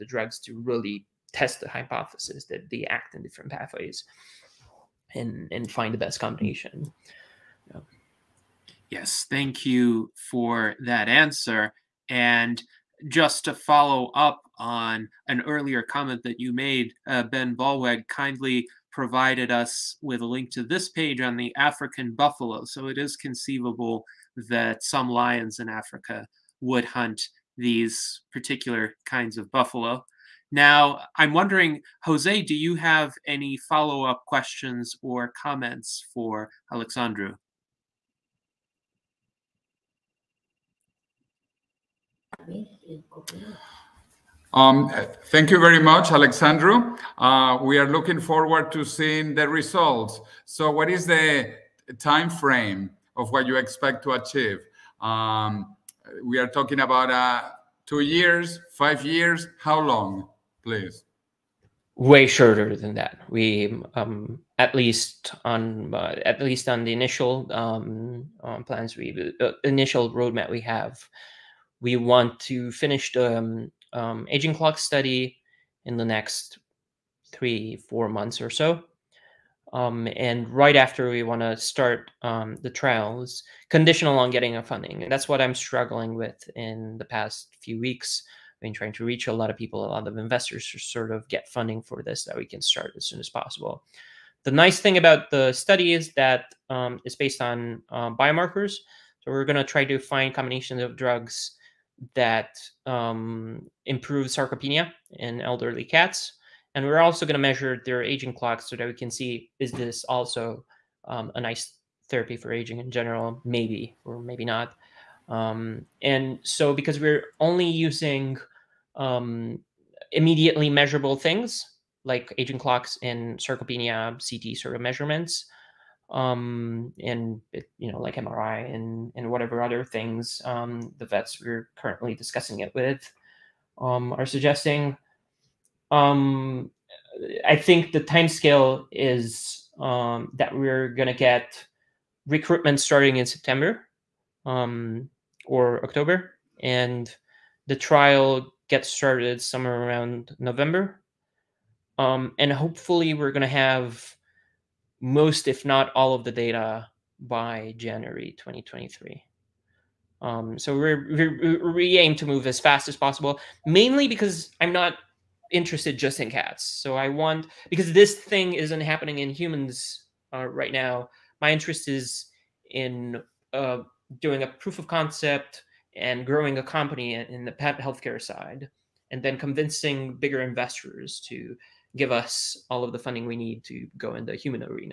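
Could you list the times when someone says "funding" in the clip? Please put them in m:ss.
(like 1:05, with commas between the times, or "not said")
1:24, 1:31, 3:02.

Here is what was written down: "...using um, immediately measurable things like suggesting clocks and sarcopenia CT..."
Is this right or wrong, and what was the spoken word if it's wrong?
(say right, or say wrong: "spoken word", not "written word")
wrong: "aging", not "suggesting".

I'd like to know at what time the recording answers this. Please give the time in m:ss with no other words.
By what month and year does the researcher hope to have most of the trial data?
2:37.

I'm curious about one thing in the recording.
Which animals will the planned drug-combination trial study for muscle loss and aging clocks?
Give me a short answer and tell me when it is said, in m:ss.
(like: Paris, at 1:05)
elderly cats, at 1:45.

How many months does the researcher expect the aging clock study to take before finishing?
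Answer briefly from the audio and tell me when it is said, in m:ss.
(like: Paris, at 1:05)
3 to 4 months, at 1:17.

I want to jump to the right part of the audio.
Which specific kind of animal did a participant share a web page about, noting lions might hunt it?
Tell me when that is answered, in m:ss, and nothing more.
0:21.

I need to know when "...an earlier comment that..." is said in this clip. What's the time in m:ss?
0:15.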